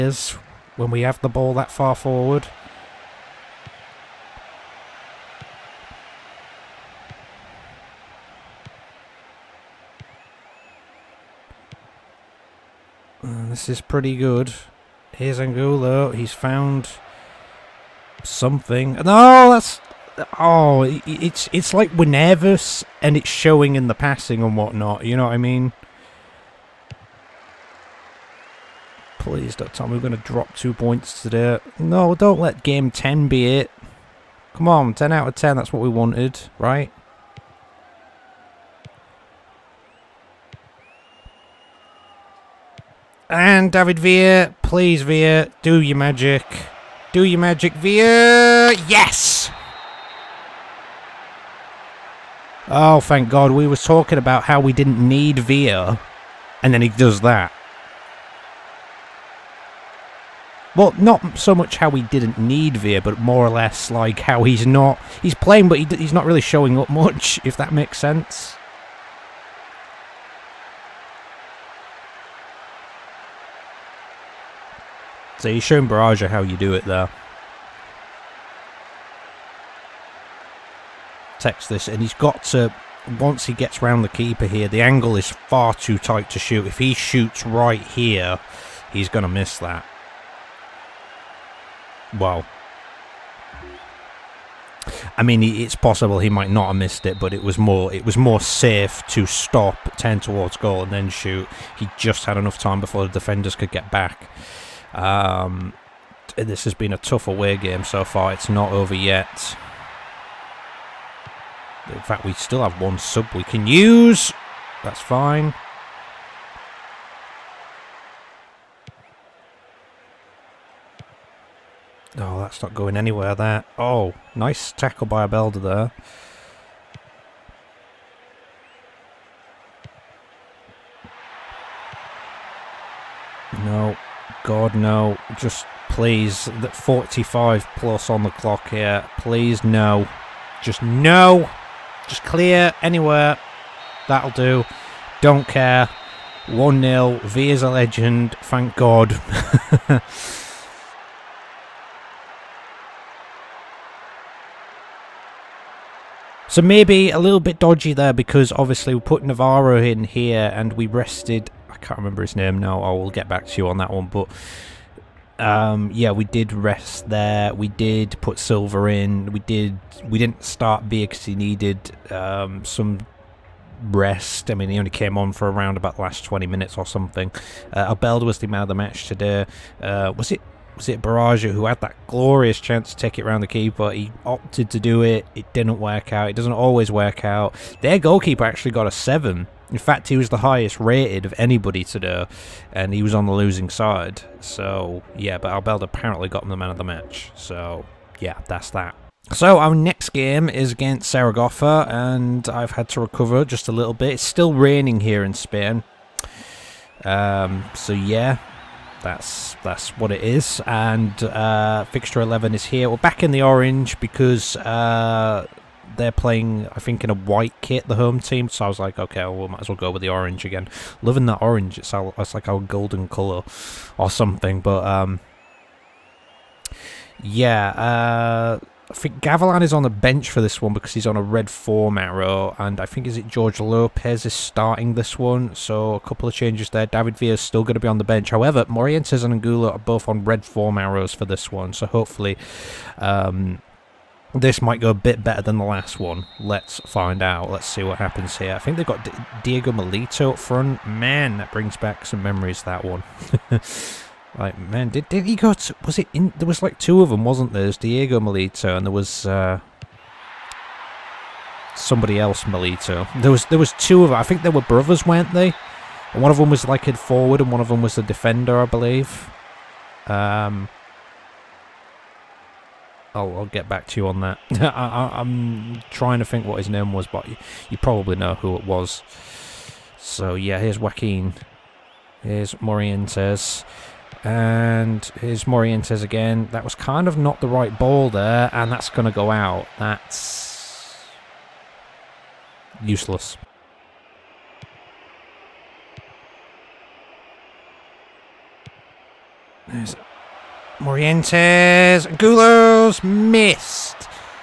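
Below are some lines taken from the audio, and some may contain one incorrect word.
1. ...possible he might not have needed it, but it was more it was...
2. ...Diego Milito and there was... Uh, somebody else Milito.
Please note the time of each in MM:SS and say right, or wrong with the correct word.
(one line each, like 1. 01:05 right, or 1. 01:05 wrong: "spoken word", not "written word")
1. 01:35 wrong: "missed", not "needed"
2. 04:17 right.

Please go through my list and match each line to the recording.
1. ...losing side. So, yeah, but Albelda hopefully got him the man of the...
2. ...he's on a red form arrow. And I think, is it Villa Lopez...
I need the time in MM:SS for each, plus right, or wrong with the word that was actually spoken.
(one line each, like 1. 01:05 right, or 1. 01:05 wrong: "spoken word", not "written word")
1. 03:13 wrong: "apparently", not "hopefully"
2. 03:50 wrong: "George", not "Villa".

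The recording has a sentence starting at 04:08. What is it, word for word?
I think they've got D Diego Milito up front.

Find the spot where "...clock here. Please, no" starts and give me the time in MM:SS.
02:18.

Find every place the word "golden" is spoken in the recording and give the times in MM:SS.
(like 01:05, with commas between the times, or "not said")
03:42.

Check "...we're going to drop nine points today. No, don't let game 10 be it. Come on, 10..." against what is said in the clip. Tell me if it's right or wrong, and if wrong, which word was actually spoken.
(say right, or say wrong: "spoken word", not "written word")
wrong: "two", not "nine".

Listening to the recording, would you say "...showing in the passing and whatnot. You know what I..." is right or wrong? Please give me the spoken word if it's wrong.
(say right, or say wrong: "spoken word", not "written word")
right.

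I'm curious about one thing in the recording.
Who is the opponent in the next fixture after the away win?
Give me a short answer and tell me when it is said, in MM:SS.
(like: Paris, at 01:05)
Saragossa, at 03:21.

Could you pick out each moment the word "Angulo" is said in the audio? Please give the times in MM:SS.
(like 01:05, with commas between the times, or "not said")
00:15, 03:59.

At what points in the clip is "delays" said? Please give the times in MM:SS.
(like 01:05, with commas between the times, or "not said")
not said.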